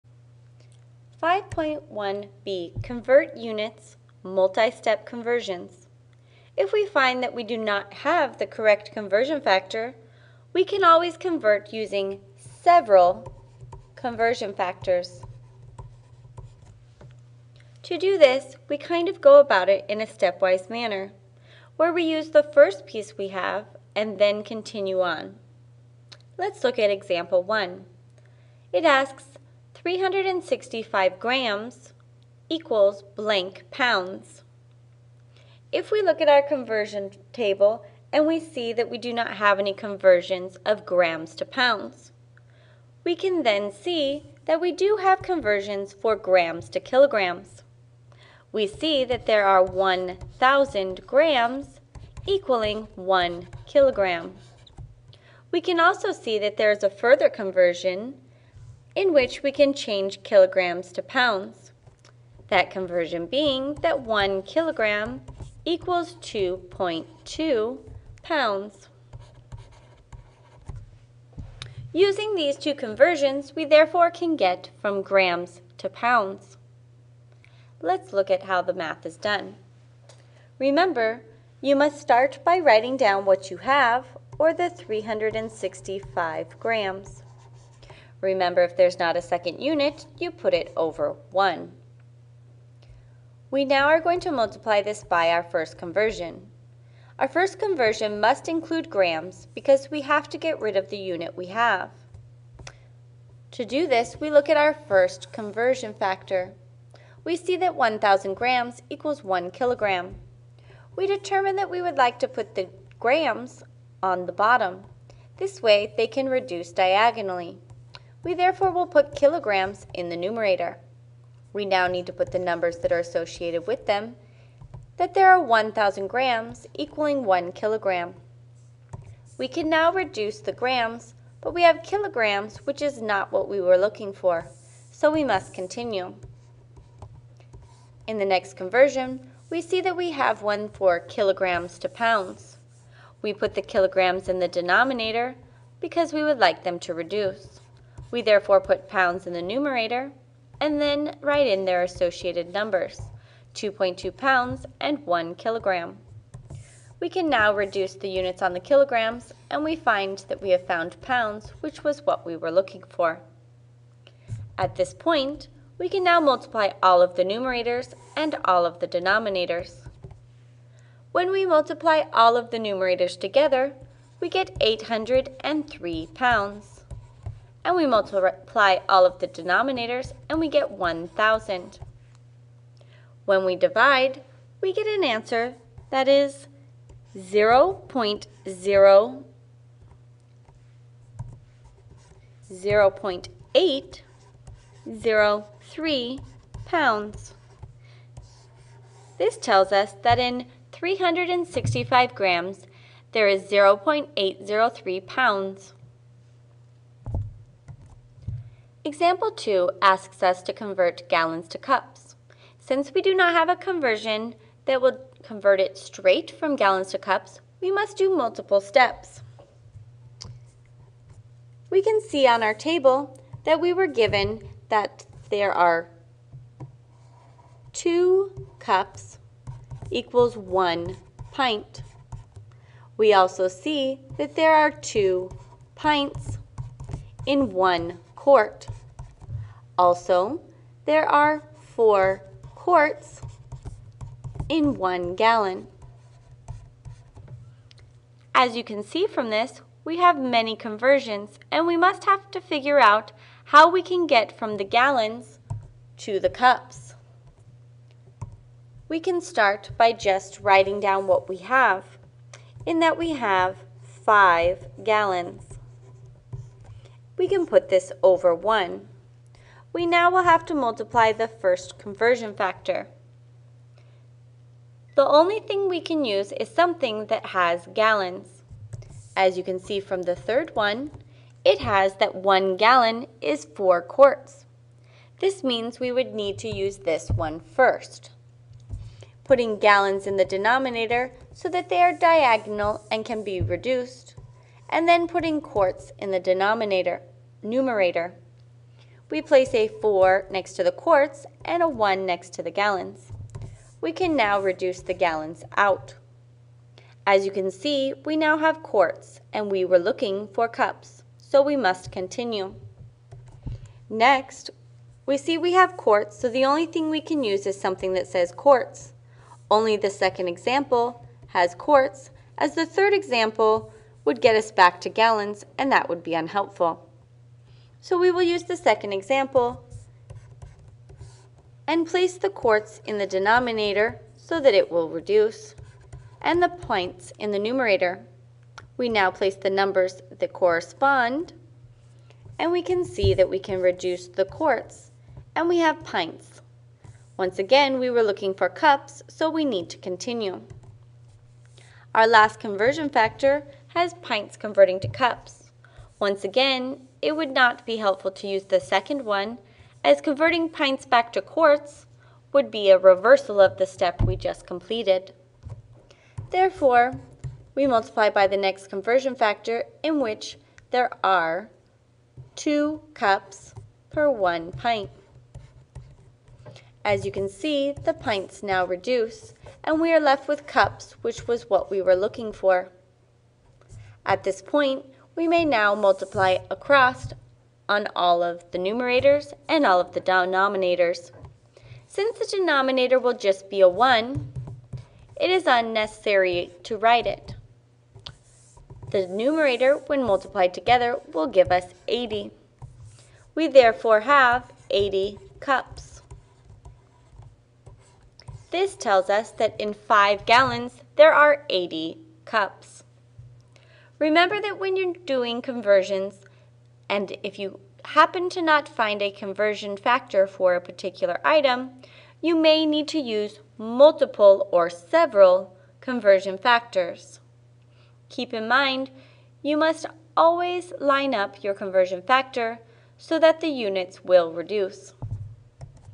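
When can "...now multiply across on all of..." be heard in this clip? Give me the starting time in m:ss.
6:25.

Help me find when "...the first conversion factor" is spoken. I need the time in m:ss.
4:31.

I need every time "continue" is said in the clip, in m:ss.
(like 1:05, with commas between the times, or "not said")
0:24, 2:15, 5:11, 5:49.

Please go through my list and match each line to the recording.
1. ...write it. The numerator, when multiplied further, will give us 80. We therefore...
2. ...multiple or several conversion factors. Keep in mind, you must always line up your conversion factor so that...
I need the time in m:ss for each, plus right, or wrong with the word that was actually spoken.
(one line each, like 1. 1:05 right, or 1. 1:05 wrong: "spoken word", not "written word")
1. 6:36 wrong: "together", not "further"
2. 7:03 right.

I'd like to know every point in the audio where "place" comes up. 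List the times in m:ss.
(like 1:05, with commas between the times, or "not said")
4:59, 5:31, 5:39.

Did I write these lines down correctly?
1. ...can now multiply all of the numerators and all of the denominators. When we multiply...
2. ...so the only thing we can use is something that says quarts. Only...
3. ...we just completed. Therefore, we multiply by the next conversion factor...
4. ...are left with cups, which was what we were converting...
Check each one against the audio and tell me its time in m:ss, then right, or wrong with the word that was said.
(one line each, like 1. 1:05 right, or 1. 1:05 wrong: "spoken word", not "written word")
1. 2:45 right
2. 5:16 right
3. 6:04 right
4. 6:19 wrong: "looking", not "converting".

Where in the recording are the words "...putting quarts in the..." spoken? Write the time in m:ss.
4:55.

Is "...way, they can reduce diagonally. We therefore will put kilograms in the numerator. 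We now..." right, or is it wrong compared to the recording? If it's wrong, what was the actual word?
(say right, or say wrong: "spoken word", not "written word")
right.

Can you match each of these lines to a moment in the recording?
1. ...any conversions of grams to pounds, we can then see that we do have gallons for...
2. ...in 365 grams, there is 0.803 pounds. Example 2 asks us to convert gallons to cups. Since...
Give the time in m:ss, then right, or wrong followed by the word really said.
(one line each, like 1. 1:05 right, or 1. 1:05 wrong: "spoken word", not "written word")
1. 0:39 wrong: "conversions", not "gallons"
2. 3:20 right.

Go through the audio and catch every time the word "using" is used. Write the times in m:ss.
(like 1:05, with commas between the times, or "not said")
0:11, 1:11.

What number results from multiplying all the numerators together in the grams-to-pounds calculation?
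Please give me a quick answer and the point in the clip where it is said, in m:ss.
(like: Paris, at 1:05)
803, at 2:54.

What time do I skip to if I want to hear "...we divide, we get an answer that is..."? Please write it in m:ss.
3:03.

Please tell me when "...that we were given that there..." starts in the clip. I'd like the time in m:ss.
3:43.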